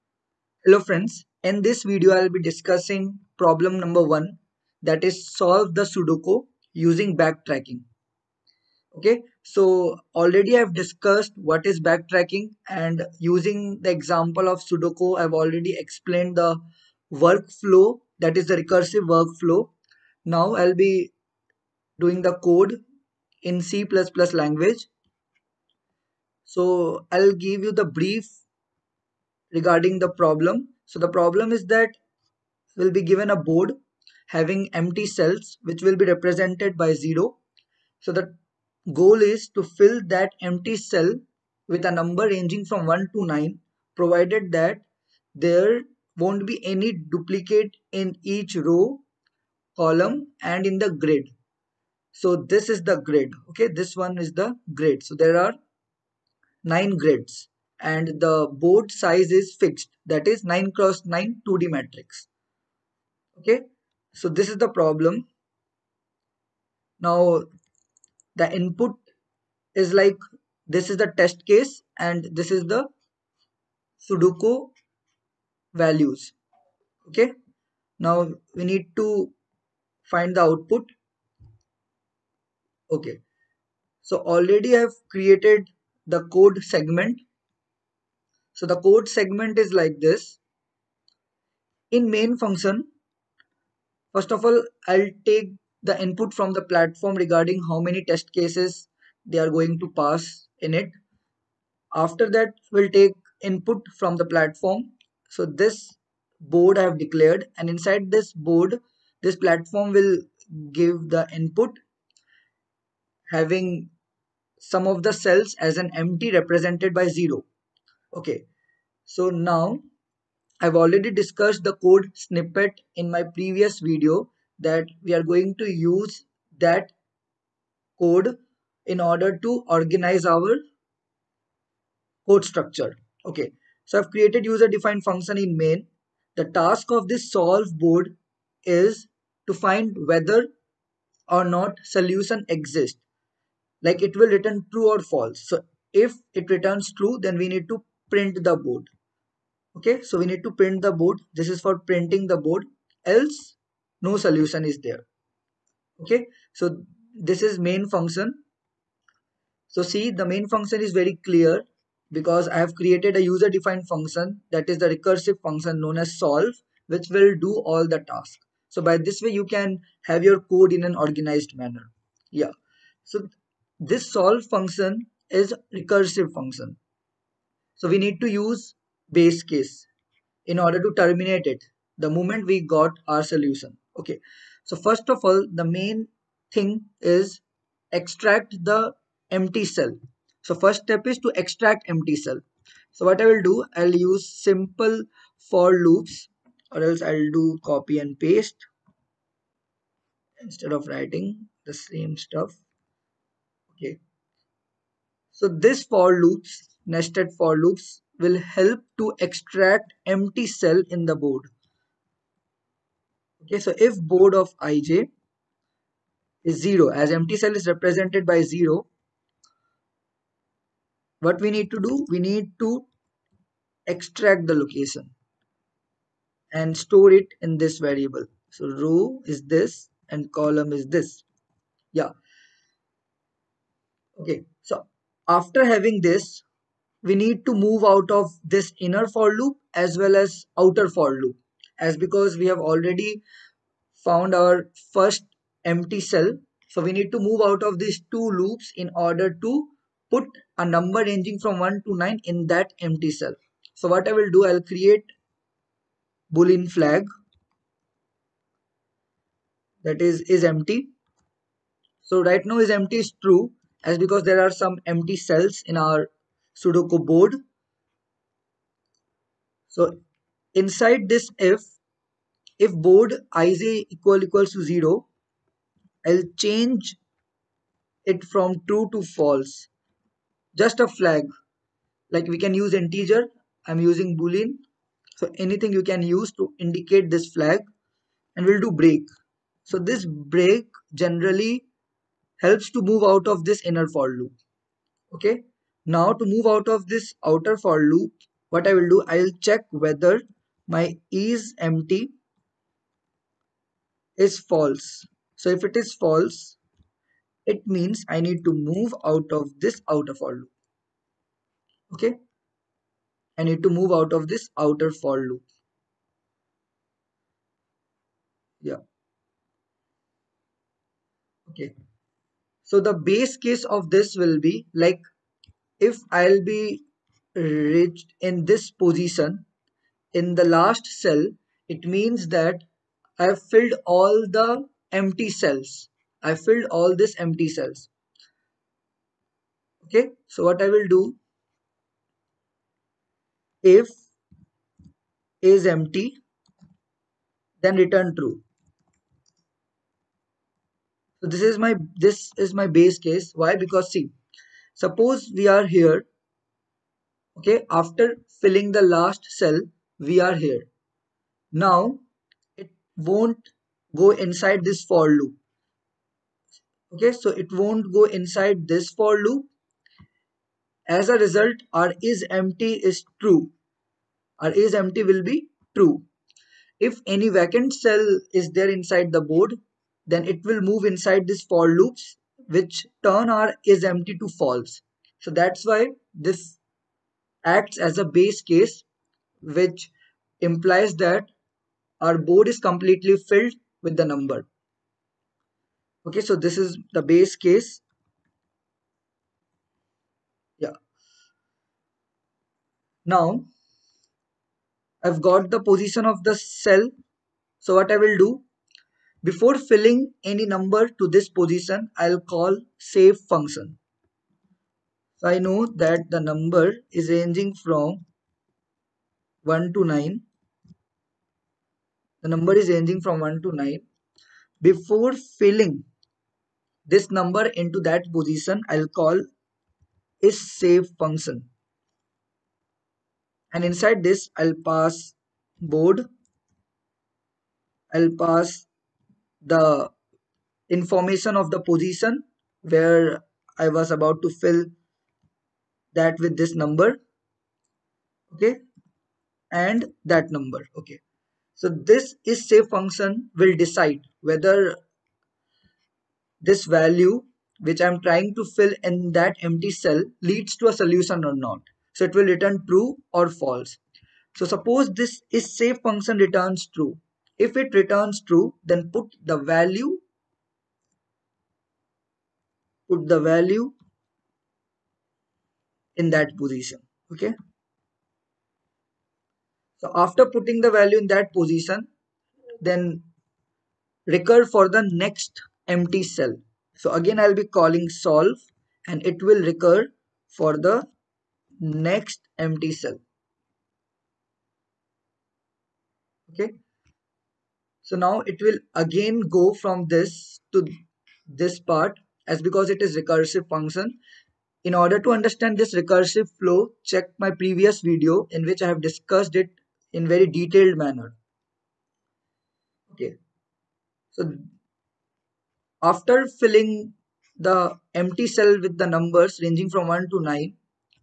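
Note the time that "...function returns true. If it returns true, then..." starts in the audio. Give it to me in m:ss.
7:45.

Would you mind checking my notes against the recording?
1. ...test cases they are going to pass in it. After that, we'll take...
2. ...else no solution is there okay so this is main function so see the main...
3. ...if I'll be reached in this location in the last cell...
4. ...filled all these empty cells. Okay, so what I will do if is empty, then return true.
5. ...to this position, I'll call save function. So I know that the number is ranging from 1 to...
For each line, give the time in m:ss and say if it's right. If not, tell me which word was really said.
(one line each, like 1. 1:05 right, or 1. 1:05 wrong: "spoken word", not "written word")
1. 1:38 right
2. 2:33 right
3. 5:25 wrong: "position", not "location"
4. 5:36 right
5. 6:50 right.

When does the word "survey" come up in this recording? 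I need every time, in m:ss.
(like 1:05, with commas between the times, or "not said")
not said.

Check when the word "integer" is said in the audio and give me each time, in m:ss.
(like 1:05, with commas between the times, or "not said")
4:42.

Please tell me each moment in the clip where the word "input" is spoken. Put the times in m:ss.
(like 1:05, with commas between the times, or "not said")
1:08, 1:35, 1:43, 1:51.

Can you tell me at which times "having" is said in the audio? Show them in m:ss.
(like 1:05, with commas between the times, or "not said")
0:34, 1:53, 3:55.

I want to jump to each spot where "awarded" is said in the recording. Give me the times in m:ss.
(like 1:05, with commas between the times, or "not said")
not said.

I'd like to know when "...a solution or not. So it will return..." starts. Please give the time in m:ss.
7:40.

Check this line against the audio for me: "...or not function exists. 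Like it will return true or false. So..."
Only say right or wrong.
wrong.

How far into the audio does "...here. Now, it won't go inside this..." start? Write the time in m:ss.
6:00.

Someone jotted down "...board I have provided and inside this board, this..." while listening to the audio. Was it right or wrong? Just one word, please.
wrong.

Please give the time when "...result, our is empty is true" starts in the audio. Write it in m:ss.
6:11.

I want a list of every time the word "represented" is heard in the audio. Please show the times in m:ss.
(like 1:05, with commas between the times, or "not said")
0:36, 1:56, 3:37.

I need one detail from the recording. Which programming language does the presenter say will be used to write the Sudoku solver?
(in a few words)
C++.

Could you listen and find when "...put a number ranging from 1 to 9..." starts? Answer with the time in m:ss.
4:10.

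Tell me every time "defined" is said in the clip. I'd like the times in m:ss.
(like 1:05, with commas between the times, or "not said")
2:14, 2:43.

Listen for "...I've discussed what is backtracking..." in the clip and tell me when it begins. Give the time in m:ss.
0:10.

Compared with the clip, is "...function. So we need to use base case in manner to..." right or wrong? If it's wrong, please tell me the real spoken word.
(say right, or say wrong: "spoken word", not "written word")
wrong: "order", not "manner".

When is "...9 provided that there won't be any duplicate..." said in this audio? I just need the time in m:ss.
0:43.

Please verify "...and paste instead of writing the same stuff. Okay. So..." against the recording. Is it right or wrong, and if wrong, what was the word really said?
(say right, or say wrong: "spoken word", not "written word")
right.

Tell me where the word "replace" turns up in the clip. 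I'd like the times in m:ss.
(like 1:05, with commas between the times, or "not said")
not said.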